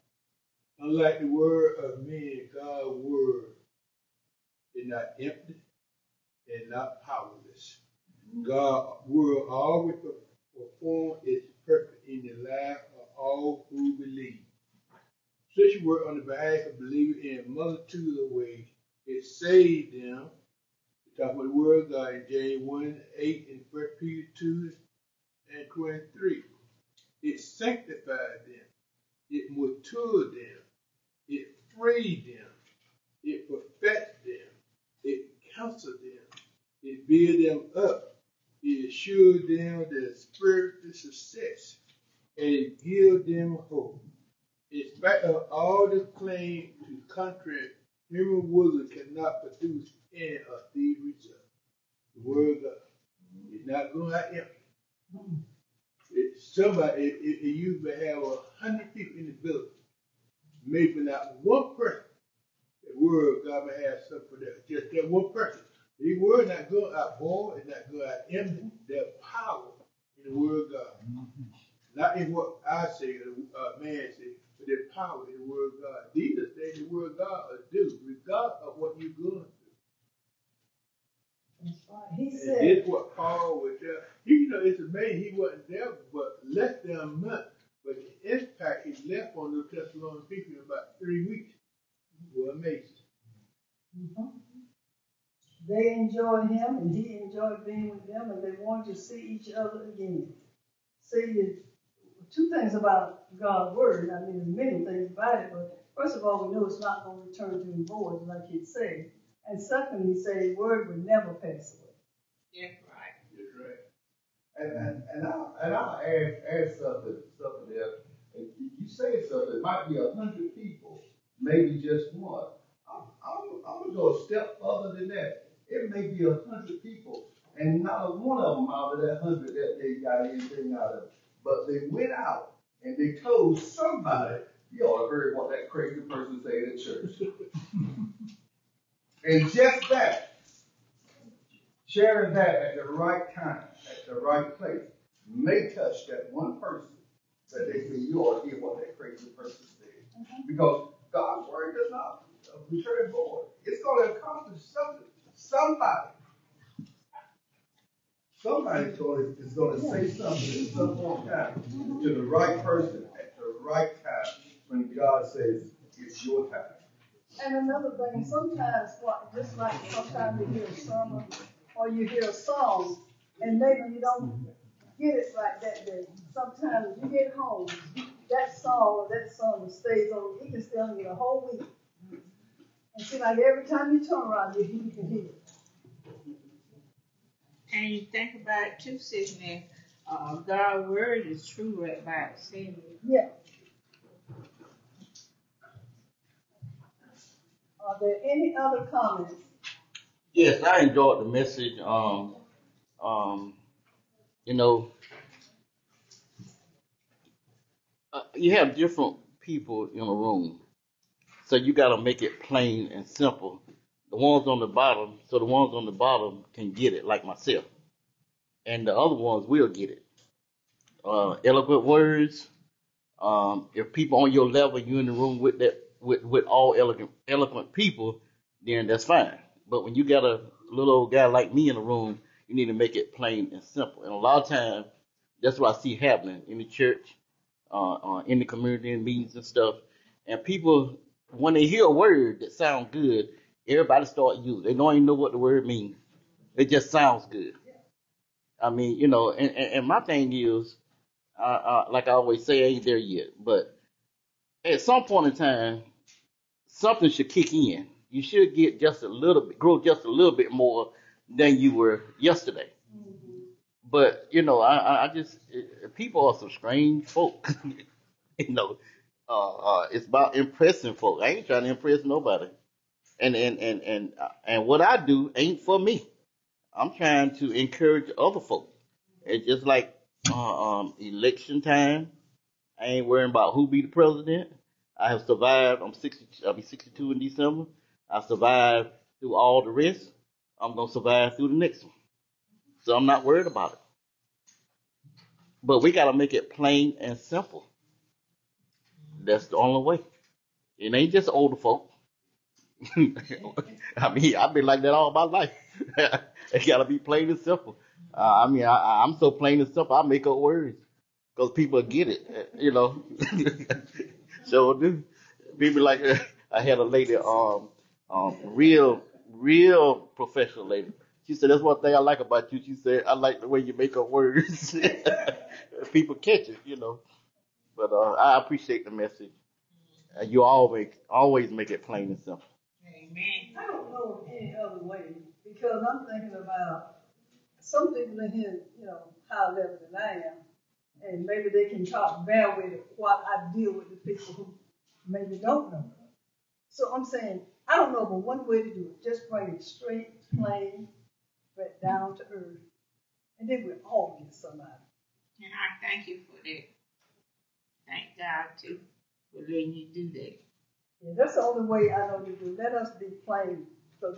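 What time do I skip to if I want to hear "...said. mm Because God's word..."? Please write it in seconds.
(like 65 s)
149 s.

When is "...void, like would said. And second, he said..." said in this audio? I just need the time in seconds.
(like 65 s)
107 s.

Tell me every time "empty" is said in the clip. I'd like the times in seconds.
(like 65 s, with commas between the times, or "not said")
5 s, 54 s.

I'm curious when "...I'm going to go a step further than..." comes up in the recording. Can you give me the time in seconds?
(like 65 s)
123 s.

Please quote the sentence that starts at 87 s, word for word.
But the impact he left on the Thessalonian people in about three weeks was amazing.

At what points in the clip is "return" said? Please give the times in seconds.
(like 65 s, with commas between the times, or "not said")
107 s, 152 s.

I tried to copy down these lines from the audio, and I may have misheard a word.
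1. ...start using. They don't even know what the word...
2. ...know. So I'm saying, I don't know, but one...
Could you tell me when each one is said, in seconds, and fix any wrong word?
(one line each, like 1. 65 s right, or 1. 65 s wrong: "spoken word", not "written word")
1. 244 s right
2. 345 s right.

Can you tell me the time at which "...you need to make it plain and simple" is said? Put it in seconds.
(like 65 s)
232 s.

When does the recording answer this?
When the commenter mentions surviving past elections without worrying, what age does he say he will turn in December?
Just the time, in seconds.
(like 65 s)
286 s.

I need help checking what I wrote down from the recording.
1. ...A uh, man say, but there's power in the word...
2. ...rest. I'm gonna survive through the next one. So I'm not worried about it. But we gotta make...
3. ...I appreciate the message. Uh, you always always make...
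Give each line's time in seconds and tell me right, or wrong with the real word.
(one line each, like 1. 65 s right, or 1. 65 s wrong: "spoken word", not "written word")
1. 73 s right
2. 289 s right
3. 328 s right.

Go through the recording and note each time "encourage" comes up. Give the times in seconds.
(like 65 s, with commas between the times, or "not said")
277 s.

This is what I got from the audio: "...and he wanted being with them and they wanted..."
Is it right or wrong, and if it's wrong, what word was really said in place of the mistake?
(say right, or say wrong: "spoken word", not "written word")
wrong: "enjoyed", not "wanted".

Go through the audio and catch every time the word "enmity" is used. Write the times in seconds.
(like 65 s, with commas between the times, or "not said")
68 s.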